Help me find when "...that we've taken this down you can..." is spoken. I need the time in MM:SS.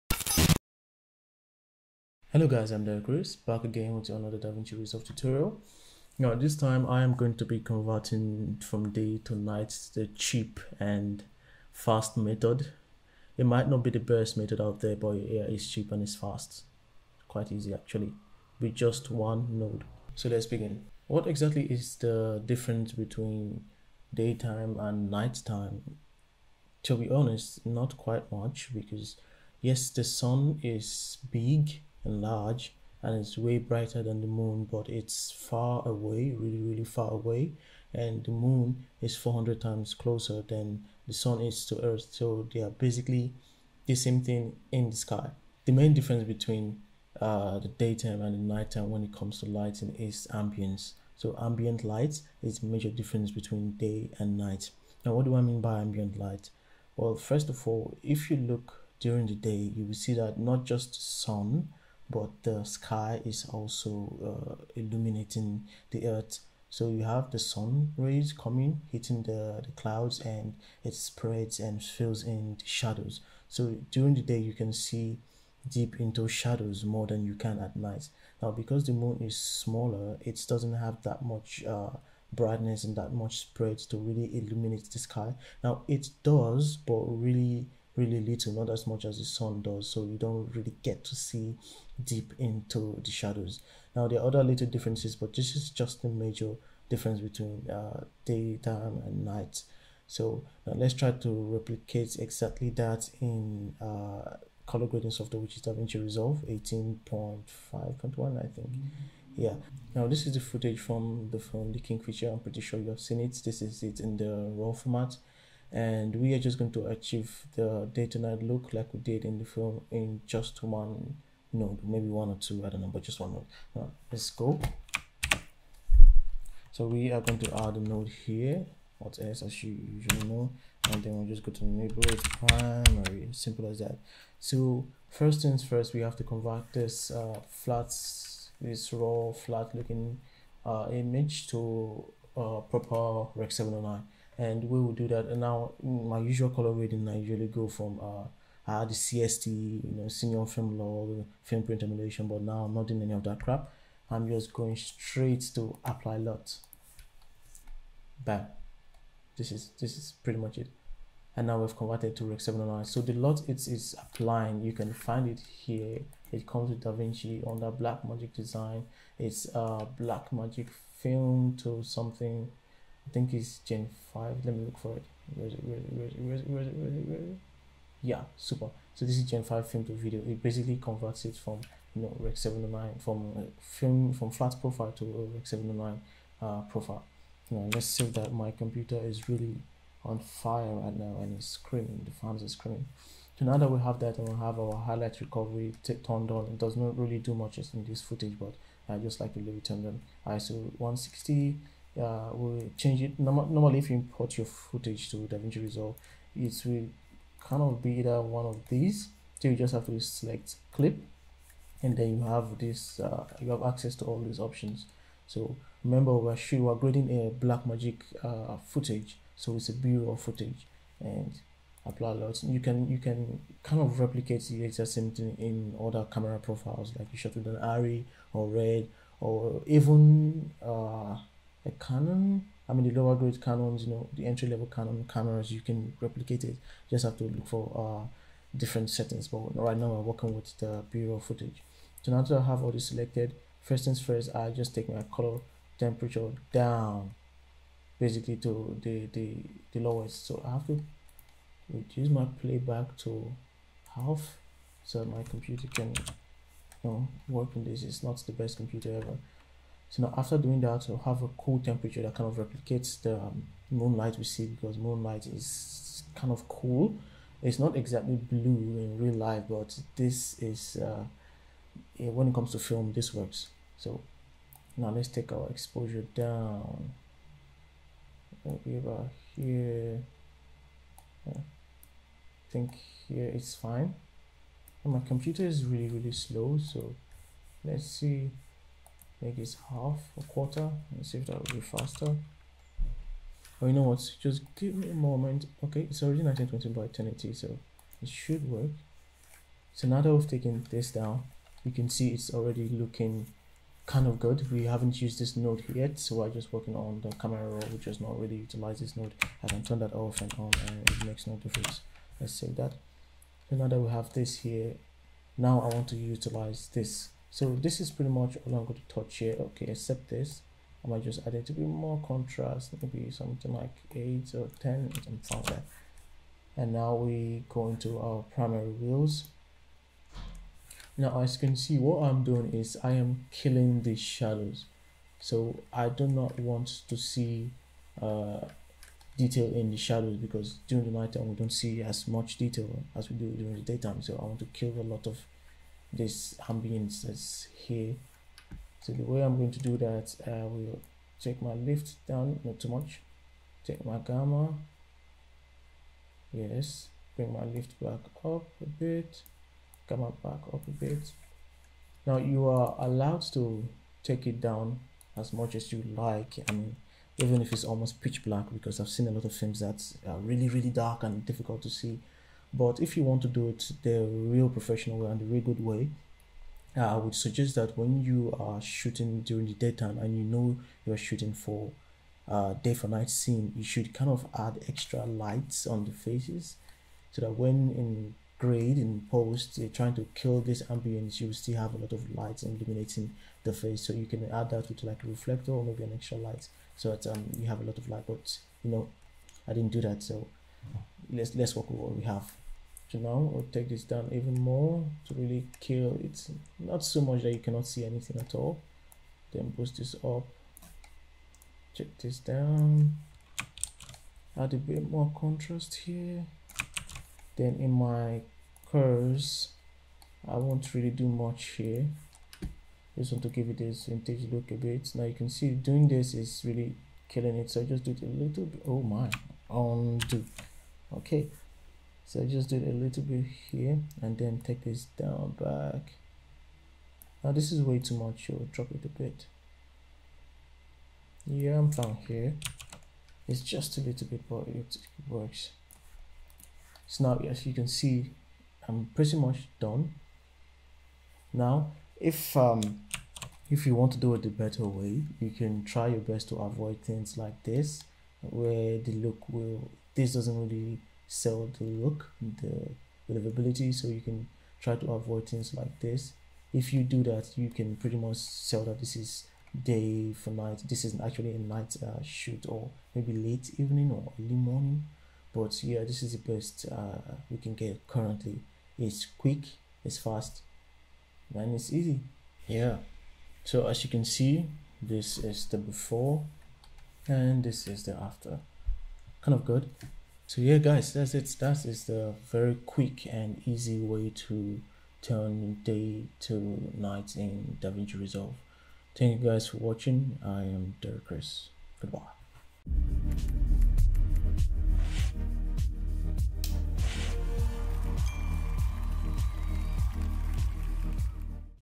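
05:00.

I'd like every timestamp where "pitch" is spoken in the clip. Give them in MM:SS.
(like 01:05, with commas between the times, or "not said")
06:08.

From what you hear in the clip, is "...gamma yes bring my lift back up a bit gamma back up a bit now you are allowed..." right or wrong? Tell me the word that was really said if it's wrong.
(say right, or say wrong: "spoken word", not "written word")
right.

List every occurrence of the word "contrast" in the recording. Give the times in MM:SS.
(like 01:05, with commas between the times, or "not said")
05:22, 06:55.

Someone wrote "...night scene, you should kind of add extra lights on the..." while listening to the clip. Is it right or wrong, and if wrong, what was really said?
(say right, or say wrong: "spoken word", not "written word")
right.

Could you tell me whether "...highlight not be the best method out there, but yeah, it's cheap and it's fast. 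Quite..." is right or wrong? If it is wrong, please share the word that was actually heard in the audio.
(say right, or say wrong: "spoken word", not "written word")
wrong: "might", not "highlight".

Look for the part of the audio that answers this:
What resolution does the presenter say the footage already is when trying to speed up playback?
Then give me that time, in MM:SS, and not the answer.
04:56.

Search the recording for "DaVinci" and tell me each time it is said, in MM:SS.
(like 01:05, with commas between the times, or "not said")
00:04, 01:45, 02:46, 03:25, 08:17.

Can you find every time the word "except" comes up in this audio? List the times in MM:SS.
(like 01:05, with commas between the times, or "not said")
05:19.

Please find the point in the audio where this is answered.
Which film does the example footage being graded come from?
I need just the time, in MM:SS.
01:51.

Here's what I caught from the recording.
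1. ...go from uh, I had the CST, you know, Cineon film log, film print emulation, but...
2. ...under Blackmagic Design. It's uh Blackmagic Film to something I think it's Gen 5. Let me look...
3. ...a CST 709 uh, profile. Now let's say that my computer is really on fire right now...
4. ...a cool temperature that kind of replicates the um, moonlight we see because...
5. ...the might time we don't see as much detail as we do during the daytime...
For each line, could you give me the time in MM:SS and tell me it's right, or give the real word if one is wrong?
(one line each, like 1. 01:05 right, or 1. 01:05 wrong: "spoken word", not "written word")
1. 02:27 right
2. 02:47 right
3. 03:05 wrong: "Rec", not "CST"
4. 04:21 right
5. 05:40 wrong: "night", not "might".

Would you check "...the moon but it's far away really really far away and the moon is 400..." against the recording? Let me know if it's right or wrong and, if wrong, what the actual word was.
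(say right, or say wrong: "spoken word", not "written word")
right.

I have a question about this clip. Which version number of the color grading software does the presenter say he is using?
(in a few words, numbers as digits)
18.5.1.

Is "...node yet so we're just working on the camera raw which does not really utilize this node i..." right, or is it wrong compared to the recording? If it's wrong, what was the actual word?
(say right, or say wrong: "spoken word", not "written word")
right.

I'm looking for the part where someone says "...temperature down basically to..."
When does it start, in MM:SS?
04:05.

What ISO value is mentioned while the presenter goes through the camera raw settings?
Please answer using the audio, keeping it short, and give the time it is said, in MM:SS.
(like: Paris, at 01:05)
160, at 03:20.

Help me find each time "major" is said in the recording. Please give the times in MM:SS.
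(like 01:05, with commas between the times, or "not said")
00:52, 01:36.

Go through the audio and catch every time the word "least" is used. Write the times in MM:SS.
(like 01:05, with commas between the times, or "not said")
not said.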